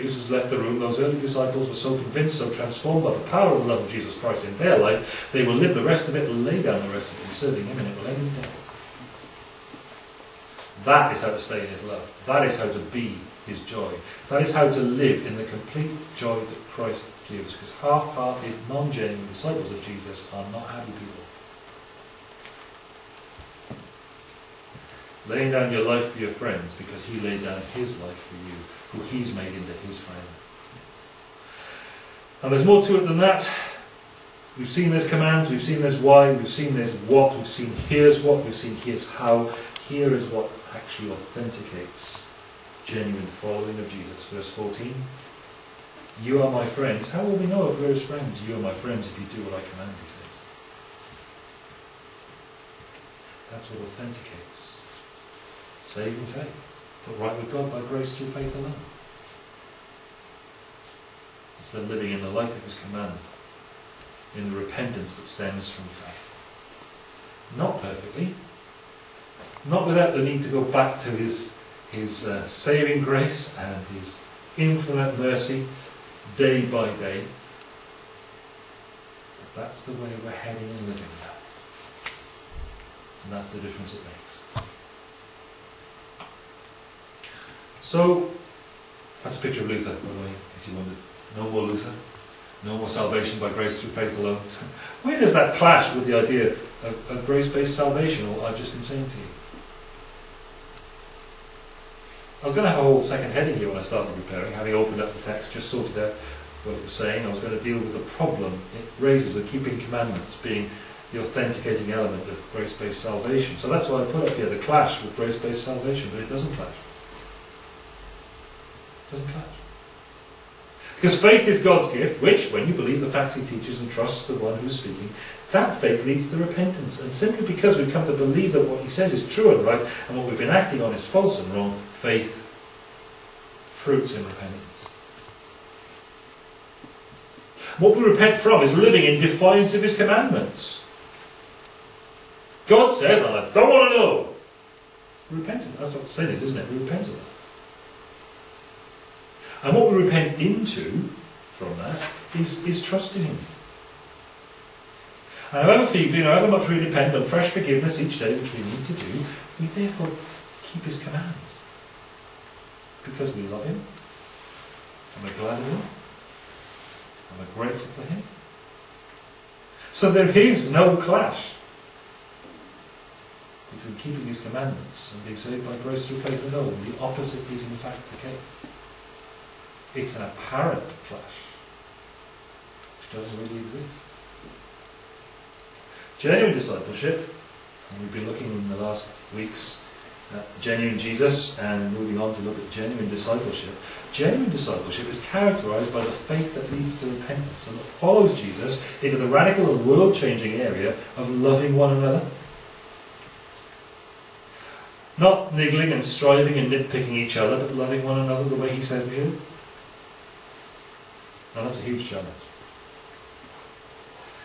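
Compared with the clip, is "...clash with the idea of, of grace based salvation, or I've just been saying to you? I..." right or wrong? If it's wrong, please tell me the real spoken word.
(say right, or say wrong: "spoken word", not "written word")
right.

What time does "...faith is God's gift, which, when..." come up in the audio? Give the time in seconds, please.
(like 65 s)
121 s.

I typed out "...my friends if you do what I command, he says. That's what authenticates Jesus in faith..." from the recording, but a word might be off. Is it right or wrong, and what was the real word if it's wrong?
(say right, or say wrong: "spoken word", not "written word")
wrong: "Saving", not "Jesus".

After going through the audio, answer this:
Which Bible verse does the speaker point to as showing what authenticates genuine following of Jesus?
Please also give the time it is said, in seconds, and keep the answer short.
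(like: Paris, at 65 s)
Verse 14, at 44 s.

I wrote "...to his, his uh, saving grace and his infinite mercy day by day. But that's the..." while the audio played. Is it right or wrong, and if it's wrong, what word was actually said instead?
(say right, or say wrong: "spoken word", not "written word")
right.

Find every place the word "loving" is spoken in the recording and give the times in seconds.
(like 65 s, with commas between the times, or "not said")
201 s, 207 s.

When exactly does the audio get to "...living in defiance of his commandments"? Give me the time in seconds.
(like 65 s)
138 s.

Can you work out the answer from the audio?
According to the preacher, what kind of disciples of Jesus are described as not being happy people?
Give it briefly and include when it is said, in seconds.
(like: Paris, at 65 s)
half-hearted, non-genuine, at 17 s.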